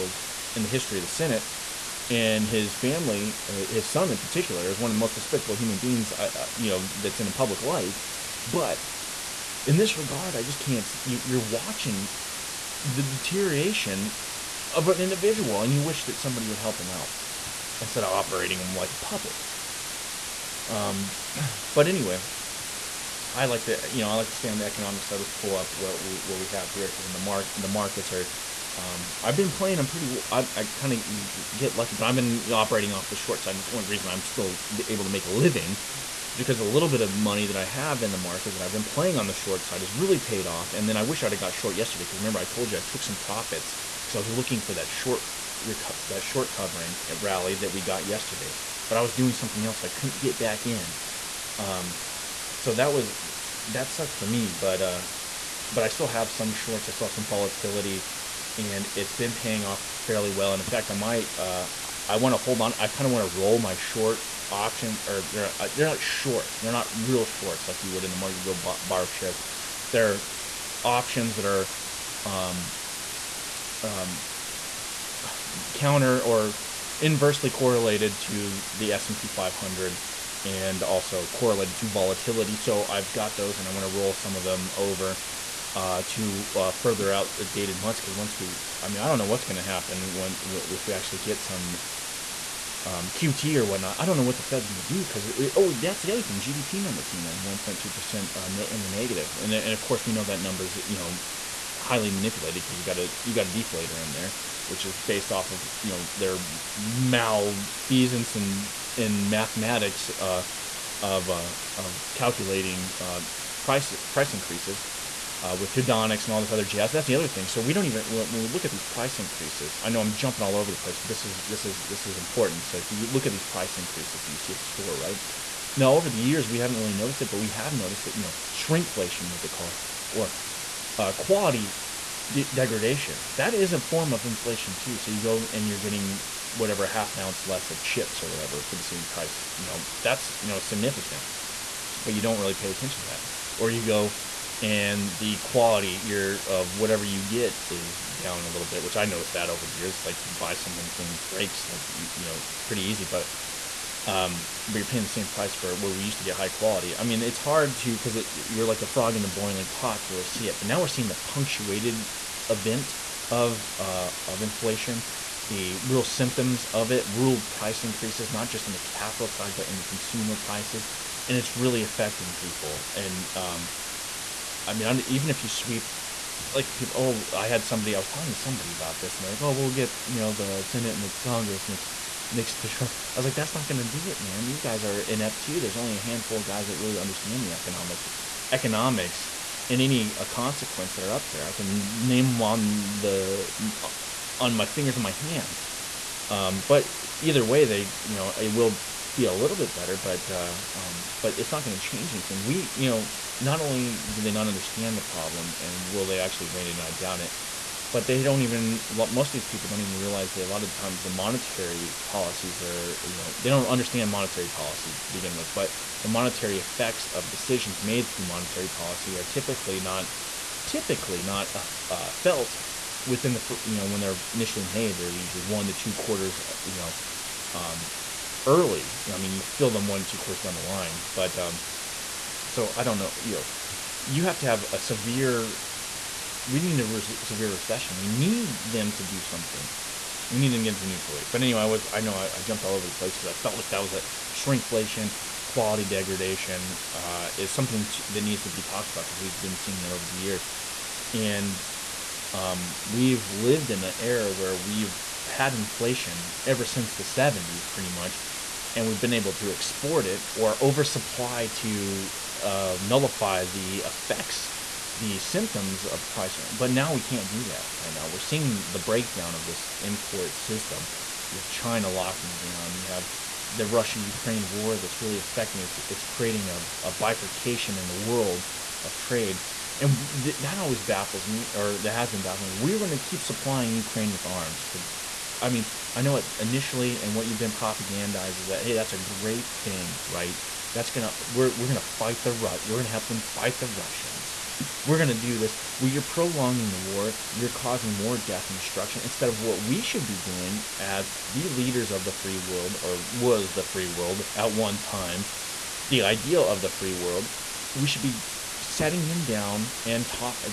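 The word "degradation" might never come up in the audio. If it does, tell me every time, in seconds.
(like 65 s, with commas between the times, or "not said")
132 s, 245 s.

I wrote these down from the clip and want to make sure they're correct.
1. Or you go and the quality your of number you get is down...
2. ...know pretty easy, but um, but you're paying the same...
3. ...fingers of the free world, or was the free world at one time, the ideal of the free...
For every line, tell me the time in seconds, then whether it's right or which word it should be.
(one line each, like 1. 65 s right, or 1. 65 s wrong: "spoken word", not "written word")
1. 143 s wrong: "whatever", not "number"
2. 152 s right
3. 301 s wrong: "leaders", not "fingers".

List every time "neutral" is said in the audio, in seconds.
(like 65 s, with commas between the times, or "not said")
240 s.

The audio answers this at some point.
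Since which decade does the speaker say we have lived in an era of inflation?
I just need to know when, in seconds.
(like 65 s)
256 s.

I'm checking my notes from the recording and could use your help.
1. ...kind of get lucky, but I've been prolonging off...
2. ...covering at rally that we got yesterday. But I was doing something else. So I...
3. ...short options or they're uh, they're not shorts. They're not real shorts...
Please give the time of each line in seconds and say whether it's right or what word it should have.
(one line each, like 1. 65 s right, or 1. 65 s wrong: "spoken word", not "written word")
1. 30 s wrong: "operating", not "prolonging"
2. 46 s right
3. 63 s right.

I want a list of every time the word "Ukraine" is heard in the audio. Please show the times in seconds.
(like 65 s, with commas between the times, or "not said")
273 s, 283 s.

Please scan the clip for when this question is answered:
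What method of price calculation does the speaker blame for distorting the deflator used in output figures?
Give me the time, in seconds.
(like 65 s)
115 s.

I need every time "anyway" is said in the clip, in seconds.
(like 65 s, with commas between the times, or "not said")
21 s, 241 s.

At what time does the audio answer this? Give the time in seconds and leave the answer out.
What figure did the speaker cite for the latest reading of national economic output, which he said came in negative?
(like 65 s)
97 s.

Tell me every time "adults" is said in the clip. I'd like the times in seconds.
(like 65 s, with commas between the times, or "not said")
not said.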